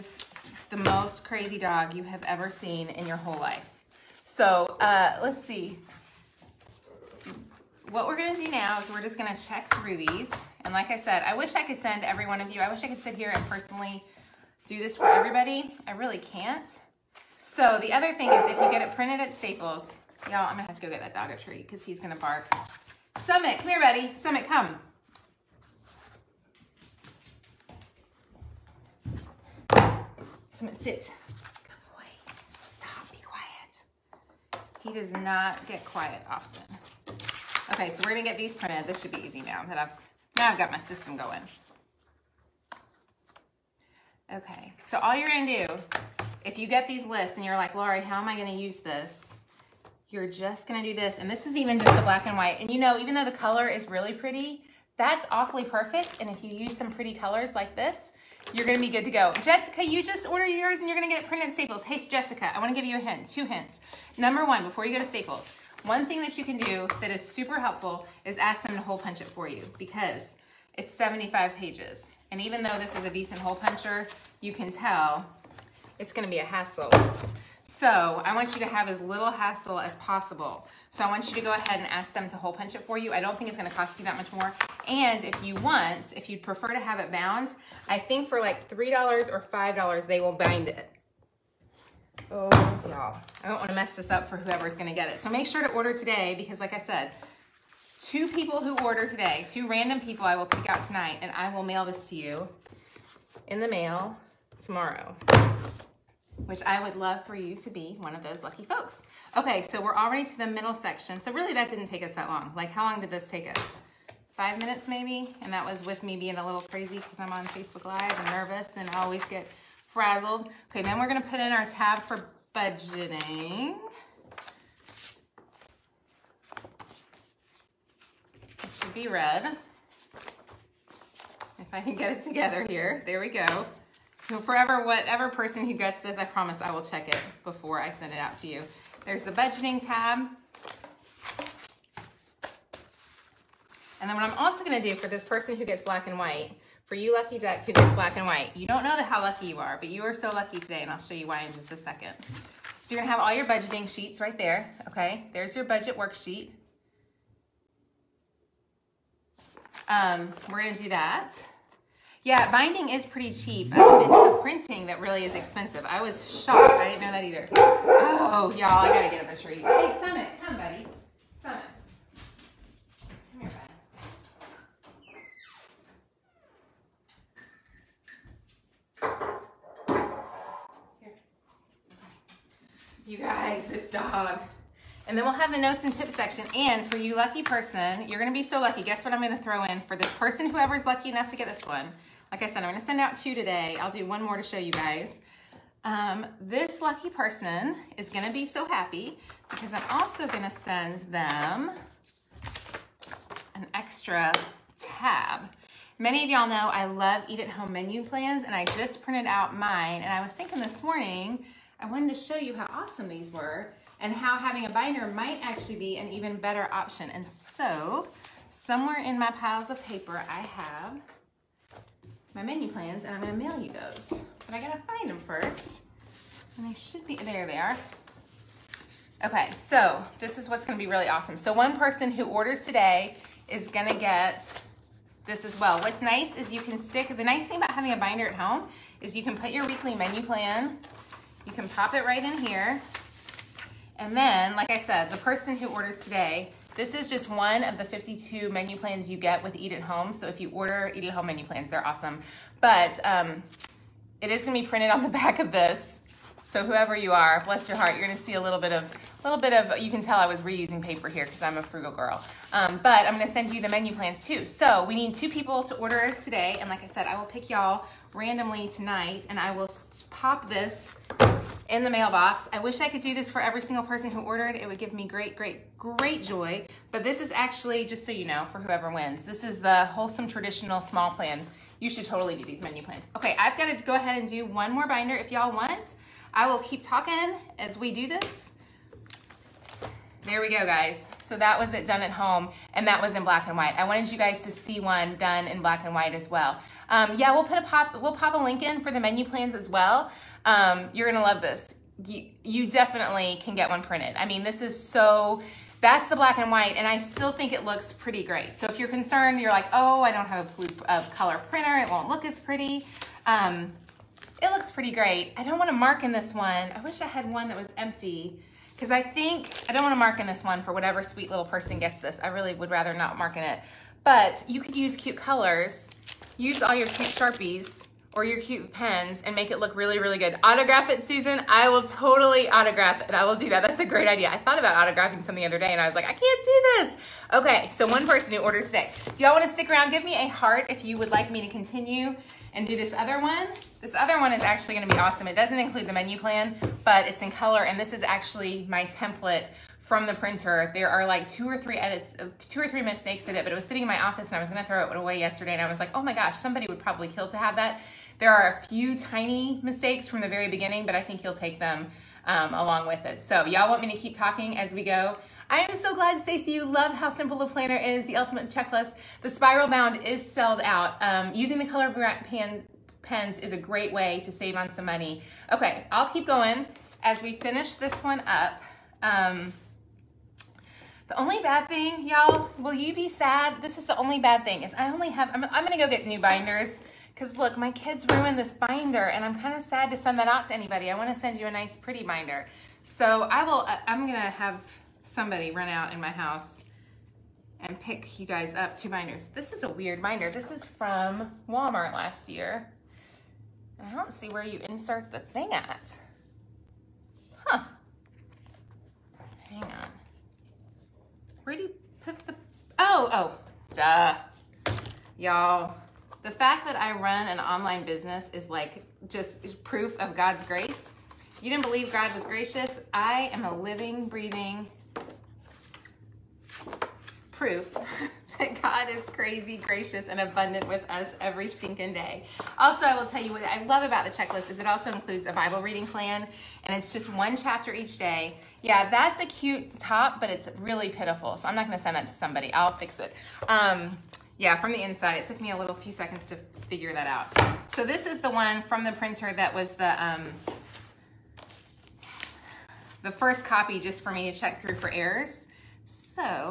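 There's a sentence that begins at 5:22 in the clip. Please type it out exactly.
I really would rather not mark in it.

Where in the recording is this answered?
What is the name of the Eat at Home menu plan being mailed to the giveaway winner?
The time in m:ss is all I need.
4:39.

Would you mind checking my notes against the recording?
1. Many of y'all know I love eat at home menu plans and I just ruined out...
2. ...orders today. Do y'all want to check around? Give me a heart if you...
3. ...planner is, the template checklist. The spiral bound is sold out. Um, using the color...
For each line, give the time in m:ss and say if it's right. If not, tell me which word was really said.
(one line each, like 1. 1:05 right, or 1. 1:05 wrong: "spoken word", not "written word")
1. 3:25 wrong: "printed", not "ruined"
2. 5:38 wrong: "stick", not "check"
3. 6:07 wrong: "ultimate", not "template".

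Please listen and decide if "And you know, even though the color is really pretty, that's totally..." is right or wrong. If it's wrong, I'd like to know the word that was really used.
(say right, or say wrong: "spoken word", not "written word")
wrong: "awfully", not "totally".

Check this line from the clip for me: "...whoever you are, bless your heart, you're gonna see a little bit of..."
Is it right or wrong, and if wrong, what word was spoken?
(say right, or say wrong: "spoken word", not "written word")
right.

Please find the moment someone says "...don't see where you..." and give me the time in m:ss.
6:43.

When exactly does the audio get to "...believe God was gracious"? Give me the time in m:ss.
7:01.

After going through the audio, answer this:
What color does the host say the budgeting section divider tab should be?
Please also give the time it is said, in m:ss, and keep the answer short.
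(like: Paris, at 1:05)
Red, at 2:09.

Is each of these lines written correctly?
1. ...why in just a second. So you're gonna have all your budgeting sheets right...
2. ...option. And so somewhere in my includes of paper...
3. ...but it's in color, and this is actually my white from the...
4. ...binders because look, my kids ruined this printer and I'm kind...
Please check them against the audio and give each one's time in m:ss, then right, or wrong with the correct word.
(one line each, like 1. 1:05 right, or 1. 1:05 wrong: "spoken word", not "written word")
1. 2:31 right
2. 3:36 wrong: "piles", not "includes"
3. 5:46 wrong: "template", not "white"
4. 6:26 wrong: "binder", not "printer".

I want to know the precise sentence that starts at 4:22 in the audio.
Um, but I'm gonna send you the menu plans too.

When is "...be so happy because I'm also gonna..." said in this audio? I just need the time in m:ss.
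3:18.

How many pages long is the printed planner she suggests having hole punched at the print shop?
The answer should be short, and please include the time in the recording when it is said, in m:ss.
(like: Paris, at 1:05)
75, at 1:10.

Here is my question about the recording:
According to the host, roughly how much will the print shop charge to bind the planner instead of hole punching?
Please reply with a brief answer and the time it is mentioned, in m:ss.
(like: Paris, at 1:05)
$3 or $5, at 1:28.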